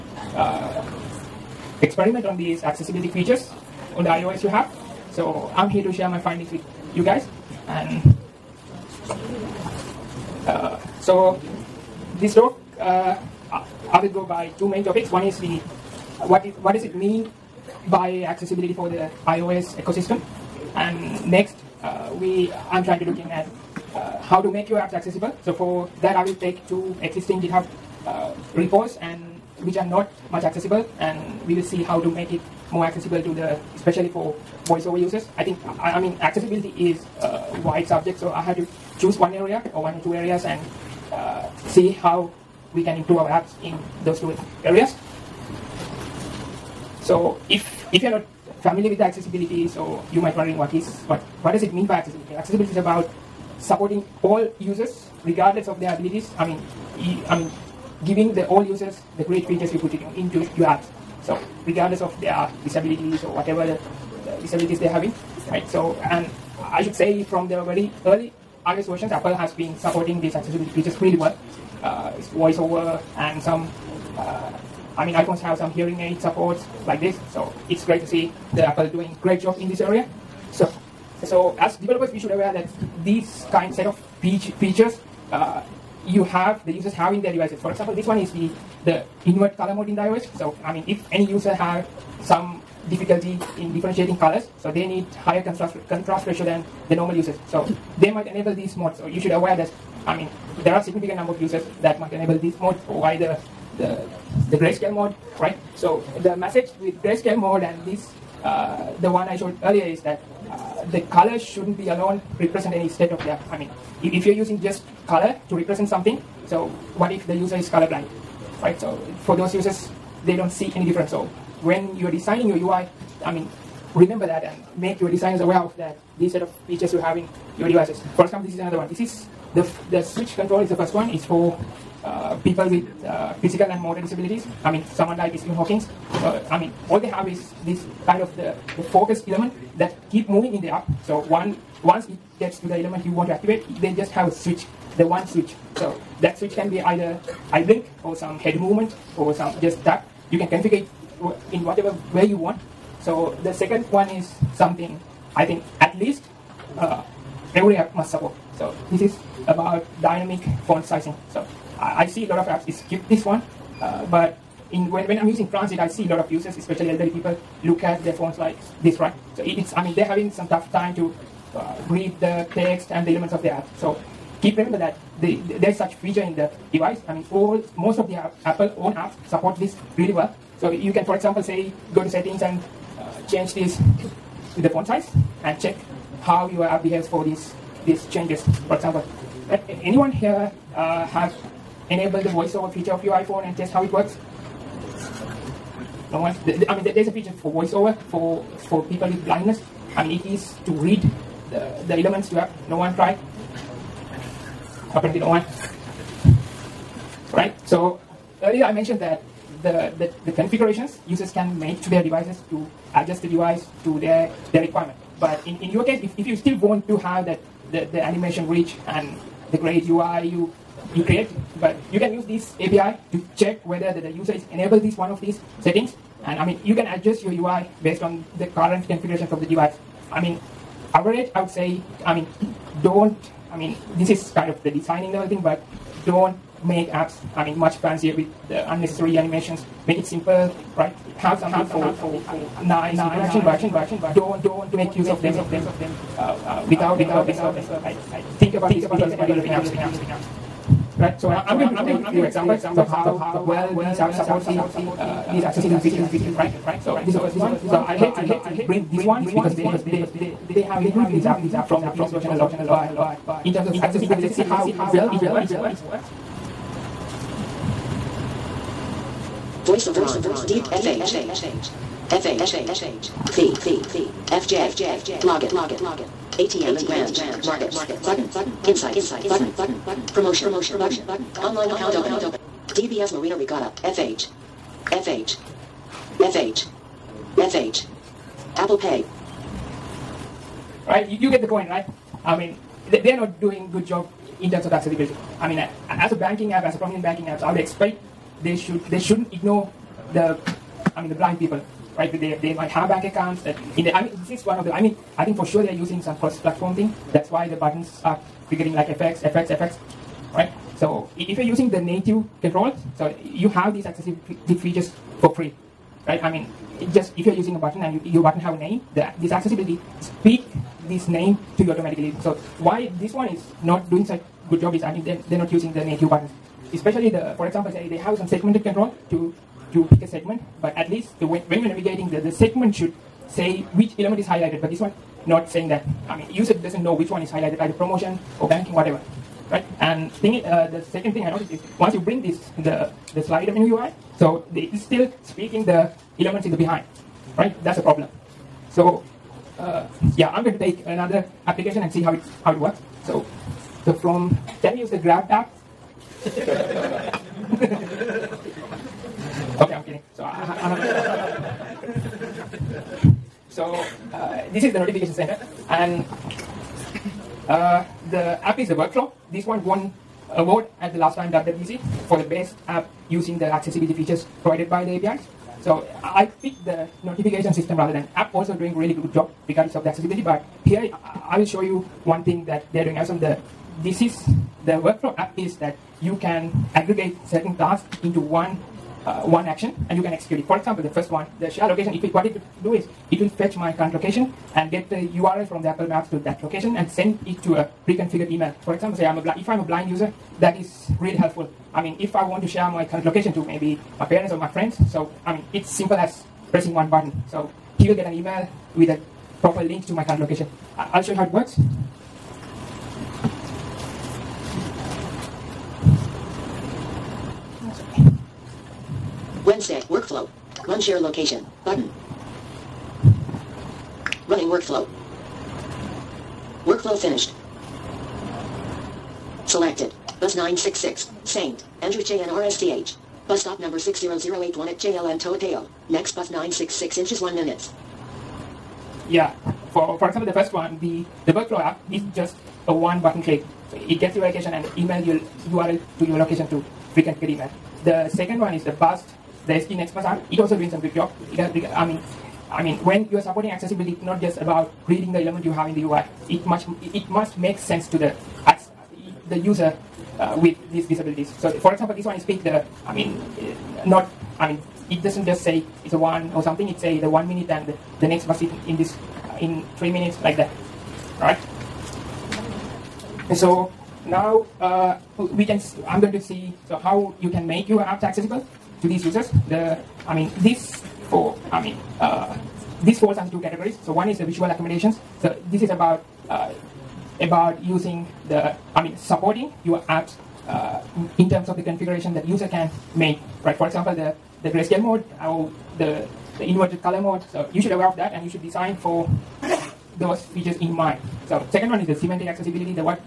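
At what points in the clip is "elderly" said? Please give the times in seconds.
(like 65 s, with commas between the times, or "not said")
166 s.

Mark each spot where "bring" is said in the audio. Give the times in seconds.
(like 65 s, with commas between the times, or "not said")
258 s, 341 s.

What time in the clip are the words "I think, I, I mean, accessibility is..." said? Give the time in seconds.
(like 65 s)
35 s.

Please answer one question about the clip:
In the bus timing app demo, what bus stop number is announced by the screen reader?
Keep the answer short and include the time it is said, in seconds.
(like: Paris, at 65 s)
60081, at 433 s.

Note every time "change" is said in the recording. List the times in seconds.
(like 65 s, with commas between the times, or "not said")
183 s, 188 s.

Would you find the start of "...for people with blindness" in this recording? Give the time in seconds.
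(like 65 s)
198 s.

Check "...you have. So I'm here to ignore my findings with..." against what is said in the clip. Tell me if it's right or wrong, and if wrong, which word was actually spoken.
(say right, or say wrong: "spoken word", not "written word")
wrong: "share", not "ignore".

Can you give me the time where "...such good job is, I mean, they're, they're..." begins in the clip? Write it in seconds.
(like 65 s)
324 s.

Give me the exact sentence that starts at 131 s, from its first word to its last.
It's for uh, people with uh, physical and motor disabilities.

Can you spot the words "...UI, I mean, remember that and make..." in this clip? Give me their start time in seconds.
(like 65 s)
122 s.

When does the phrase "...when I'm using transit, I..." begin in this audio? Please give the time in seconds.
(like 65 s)
165 s.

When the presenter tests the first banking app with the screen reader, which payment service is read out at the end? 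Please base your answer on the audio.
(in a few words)
Apple Pay.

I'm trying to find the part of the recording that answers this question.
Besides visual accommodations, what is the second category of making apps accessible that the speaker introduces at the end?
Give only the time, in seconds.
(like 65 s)
501 s.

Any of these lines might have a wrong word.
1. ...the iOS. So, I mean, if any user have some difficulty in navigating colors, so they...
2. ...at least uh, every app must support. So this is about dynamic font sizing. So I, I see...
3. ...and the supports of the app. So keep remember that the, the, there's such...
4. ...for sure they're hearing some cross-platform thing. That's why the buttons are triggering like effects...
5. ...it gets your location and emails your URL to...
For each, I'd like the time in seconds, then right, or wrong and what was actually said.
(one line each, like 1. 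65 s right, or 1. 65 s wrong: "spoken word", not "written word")
1. 89 s wrong: "differentiating", not "navigating"
2. 155 s right
3. 172 s wrong: "elements", not "supports"
4. 305 s wrong: "using", not "hearing"
5. 443 s right.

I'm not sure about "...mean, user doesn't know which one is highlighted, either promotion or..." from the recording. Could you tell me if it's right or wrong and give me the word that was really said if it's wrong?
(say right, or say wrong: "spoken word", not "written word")
right.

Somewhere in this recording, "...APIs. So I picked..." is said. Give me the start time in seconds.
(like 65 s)
375 s.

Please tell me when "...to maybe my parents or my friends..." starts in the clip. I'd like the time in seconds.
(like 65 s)
403 s.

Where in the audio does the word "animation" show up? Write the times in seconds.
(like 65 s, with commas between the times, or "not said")
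218 s, 239 s.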